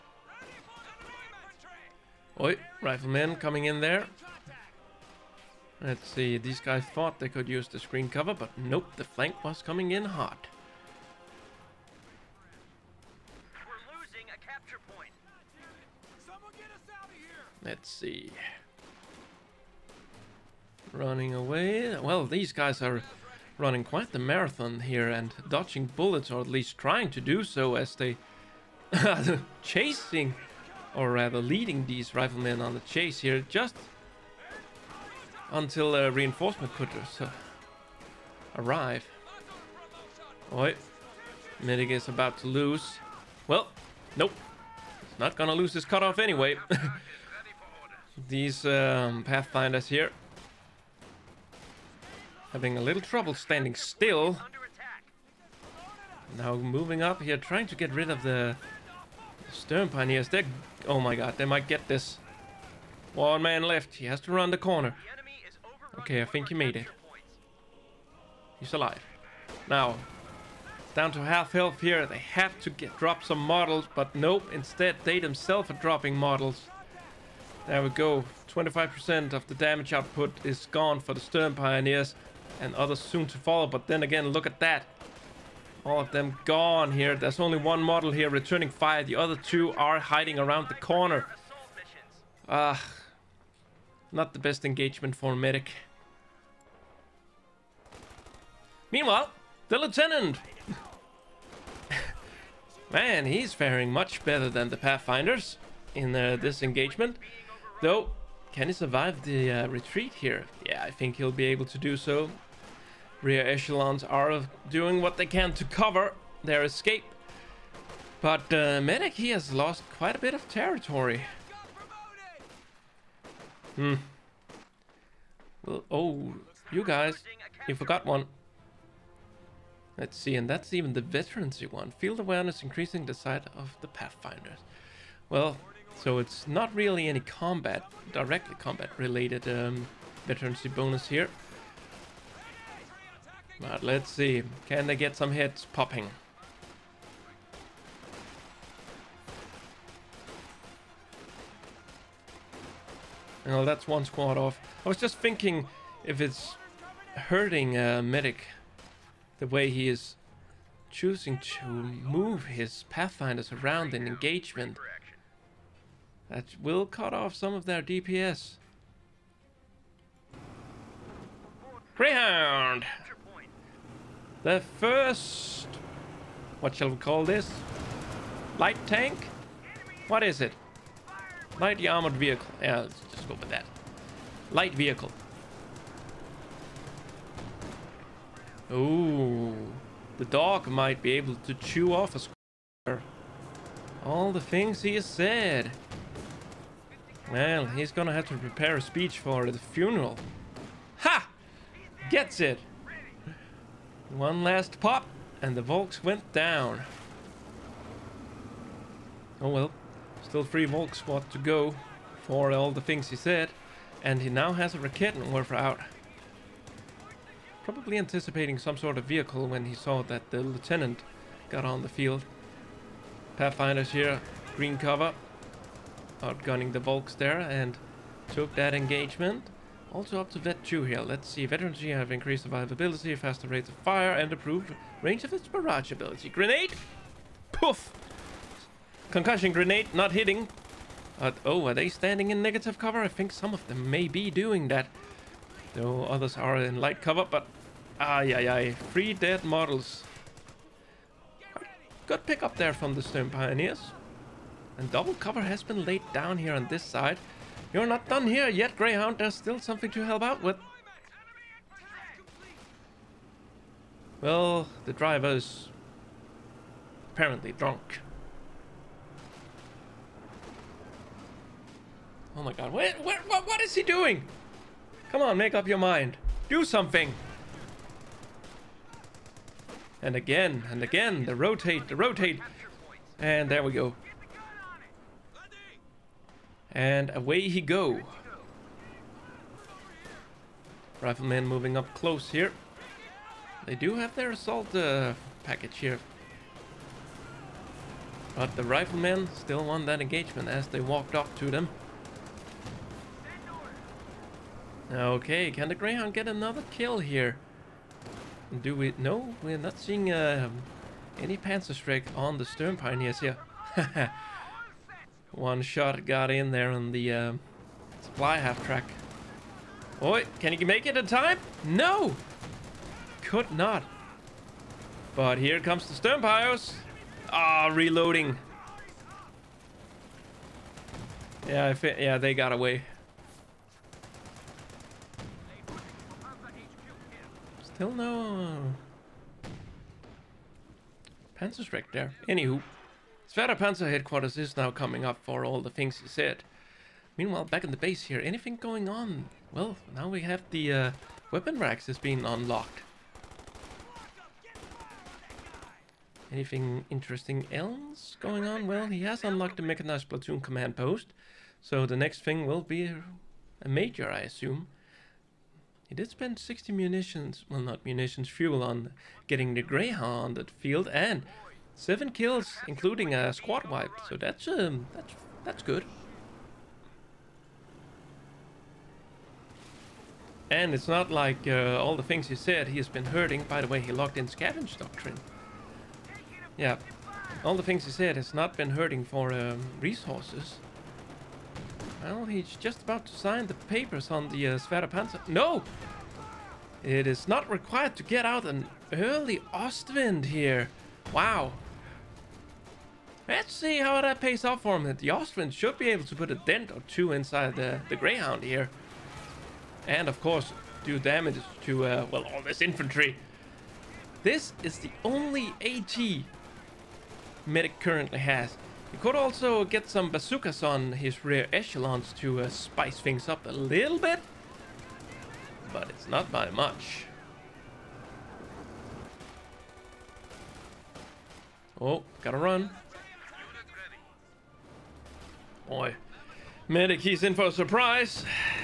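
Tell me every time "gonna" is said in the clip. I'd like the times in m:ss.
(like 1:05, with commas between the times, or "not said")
0:45, 3:17.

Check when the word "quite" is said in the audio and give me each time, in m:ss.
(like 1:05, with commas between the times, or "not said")
0:23, 1:59.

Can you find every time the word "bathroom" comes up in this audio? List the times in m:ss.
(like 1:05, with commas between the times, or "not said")
not said.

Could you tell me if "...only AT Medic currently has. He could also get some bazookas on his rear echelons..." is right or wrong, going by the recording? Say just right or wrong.
right.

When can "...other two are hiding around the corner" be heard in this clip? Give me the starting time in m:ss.
1:29.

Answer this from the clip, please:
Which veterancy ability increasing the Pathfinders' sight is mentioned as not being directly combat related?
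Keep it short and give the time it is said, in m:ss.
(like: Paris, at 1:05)
Field awareness, at 2:11.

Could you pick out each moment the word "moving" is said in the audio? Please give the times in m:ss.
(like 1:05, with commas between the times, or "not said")
0:56, 4:51.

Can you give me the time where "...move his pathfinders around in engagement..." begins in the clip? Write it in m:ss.
2:41.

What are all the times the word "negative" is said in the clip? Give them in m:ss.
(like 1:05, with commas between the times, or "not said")
4:02.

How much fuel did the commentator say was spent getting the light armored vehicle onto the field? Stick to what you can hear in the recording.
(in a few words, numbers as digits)
60.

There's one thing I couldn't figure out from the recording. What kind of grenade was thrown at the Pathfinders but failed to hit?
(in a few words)
Concussion grenade.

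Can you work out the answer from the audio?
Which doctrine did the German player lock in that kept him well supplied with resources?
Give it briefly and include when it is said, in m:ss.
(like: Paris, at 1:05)
Scavenge doctrine, at 6:24.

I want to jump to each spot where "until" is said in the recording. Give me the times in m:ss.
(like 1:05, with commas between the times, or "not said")
0:35.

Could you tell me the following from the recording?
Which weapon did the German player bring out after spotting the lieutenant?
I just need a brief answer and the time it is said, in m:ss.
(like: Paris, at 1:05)
Raketenwerfer, at 3:34.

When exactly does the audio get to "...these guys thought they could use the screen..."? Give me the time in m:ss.
0:06.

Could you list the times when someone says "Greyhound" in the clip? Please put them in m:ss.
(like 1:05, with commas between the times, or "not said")
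2:51, 4:18, 5:05, 6:09, 6:47.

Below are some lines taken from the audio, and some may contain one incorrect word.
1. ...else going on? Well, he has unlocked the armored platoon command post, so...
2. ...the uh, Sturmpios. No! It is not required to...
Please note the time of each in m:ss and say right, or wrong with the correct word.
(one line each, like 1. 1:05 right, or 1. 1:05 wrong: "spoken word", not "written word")
1. 5:57 wrong: "mechanized", not "armored"
2. 6:34 wrong: "Panzer", not "Sturmpios".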